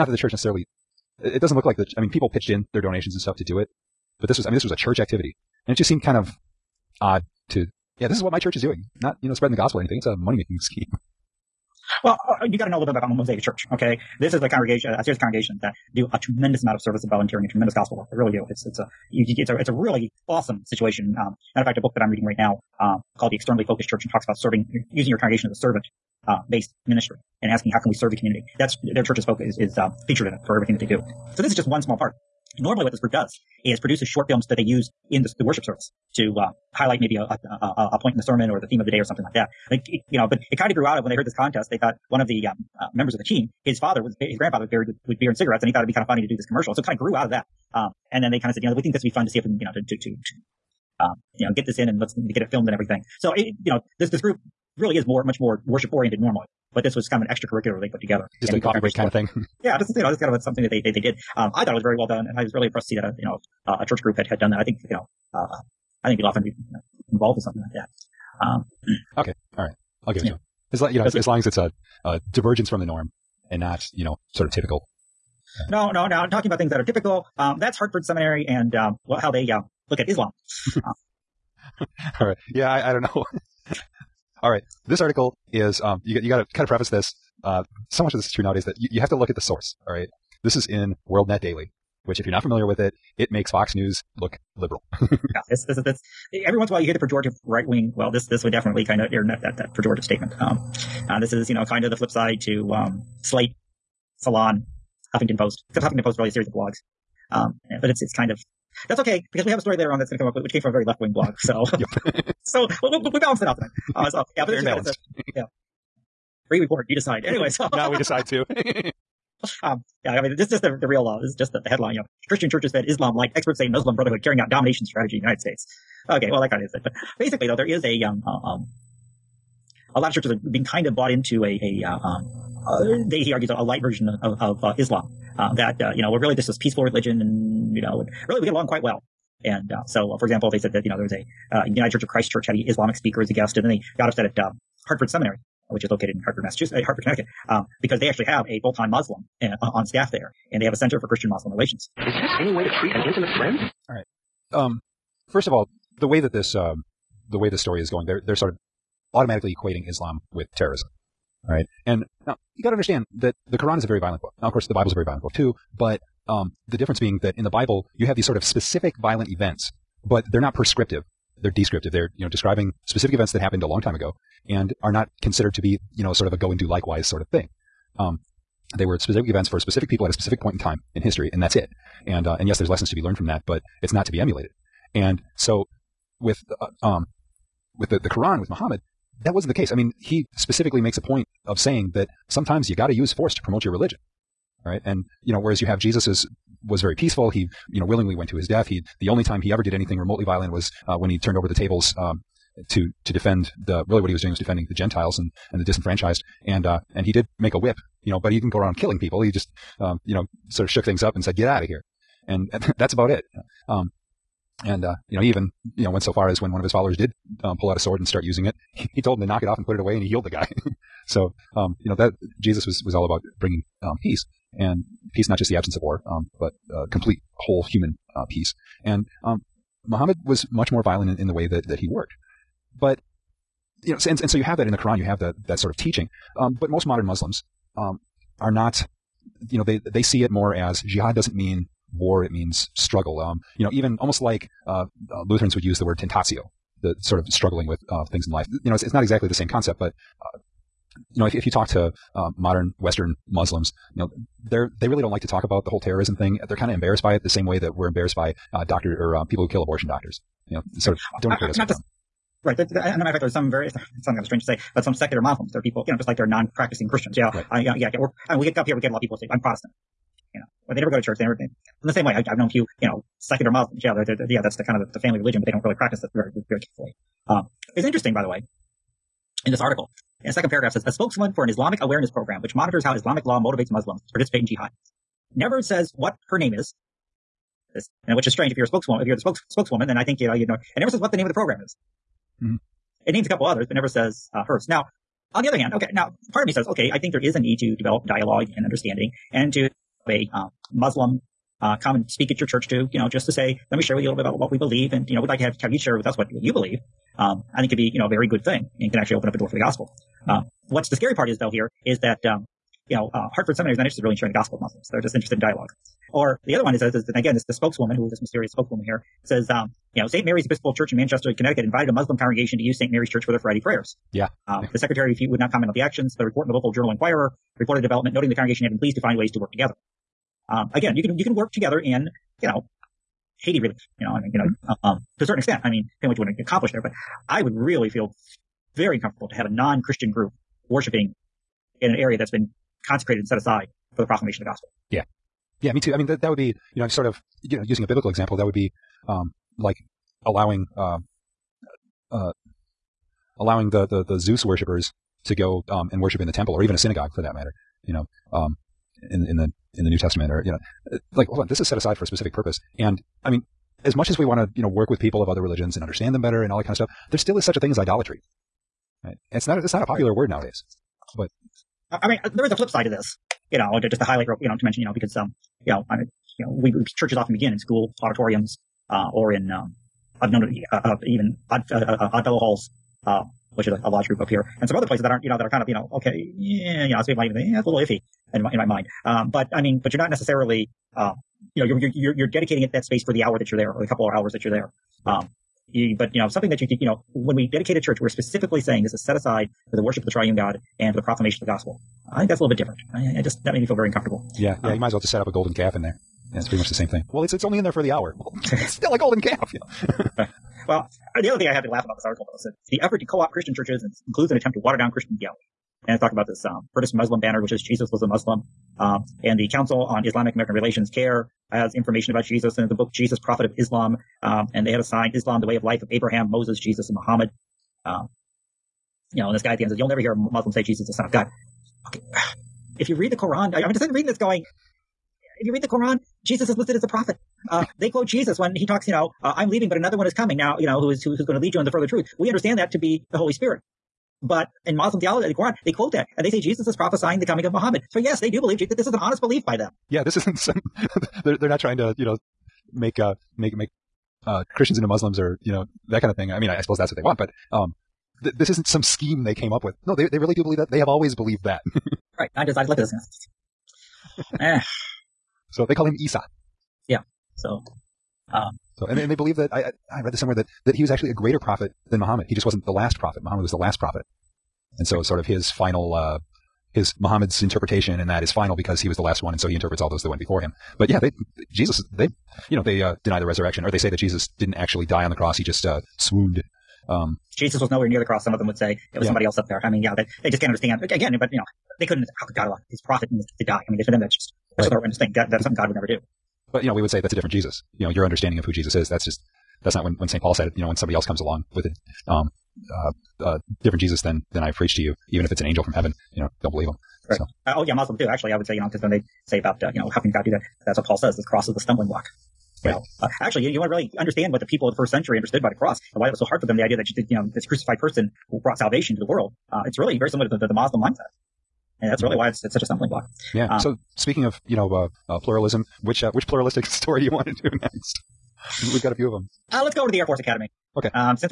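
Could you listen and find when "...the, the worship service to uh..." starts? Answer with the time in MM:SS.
00:35.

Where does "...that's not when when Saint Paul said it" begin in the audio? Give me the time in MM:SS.
08:19.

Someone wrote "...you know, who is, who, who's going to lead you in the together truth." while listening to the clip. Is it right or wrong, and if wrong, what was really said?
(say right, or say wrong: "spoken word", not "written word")
wrong: "further", not "together".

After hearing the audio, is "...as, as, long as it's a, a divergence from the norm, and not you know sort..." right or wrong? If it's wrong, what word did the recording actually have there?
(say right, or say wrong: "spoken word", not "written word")
right.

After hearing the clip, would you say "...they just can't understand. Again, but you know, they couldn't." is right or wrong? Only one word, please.
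right.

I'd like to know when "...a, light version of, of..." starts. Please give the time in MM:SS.
02:13.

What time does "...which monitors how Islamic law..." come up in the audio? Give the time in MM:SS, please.
04:42.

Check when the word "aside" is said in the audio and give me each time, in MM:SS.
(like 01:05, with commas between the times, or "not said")
05:43, 06:01, 06:39.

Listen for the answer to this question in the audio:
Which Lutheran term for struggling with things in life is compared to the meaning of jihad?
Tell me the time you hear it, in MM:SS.
04:05.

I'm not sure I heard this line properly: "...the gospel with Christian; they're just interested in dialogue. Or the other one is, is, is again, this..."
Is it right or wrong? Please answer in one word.
wrong.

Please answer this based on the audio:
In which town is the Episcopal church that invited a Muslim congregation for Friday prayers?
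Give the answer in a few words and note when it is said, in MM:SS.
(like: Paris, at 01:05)
Manchester, Connecticut, at 05:20.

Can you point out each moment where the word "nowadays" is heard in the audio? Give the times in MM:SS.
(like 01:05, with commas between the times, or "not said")
01:28, 06:10.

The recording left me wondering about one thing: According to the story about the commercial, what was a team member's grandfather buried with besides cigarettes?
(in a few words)
Beer.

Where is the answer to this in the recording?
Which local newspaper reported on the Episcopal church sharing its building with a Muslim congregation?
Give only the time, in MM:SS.
05:26.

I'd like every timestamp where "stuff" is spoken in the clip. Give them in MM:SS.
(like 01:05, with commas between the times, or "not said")
00:03, 06:06.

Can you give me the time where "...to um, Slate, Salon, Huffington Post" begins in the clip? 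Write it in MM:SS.
01:42.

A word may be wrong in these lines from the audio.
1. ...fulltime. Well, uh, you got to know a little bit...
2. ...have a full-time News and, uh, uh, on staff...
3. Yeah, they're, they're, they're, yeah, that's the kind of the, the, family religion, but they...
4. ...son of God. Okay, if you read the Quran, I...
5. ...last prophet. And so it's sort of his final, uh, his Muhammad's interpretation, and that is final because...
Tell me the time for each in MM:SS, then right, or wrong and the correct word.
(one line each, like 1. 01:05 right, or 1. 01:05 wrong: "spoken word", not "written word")
1. 00:10 wrong: "scheme", not "fulltime"
2. 02:28 wrong: "Muslim", not "News"
3. 04:33 right
4. 07:10 right
5. 07:53 right.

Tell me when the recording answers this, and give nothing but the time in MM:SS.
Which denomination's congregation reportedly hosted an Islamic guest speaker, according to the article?
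02:21.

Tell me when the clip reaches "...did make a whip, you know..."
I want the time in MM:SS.
03:27.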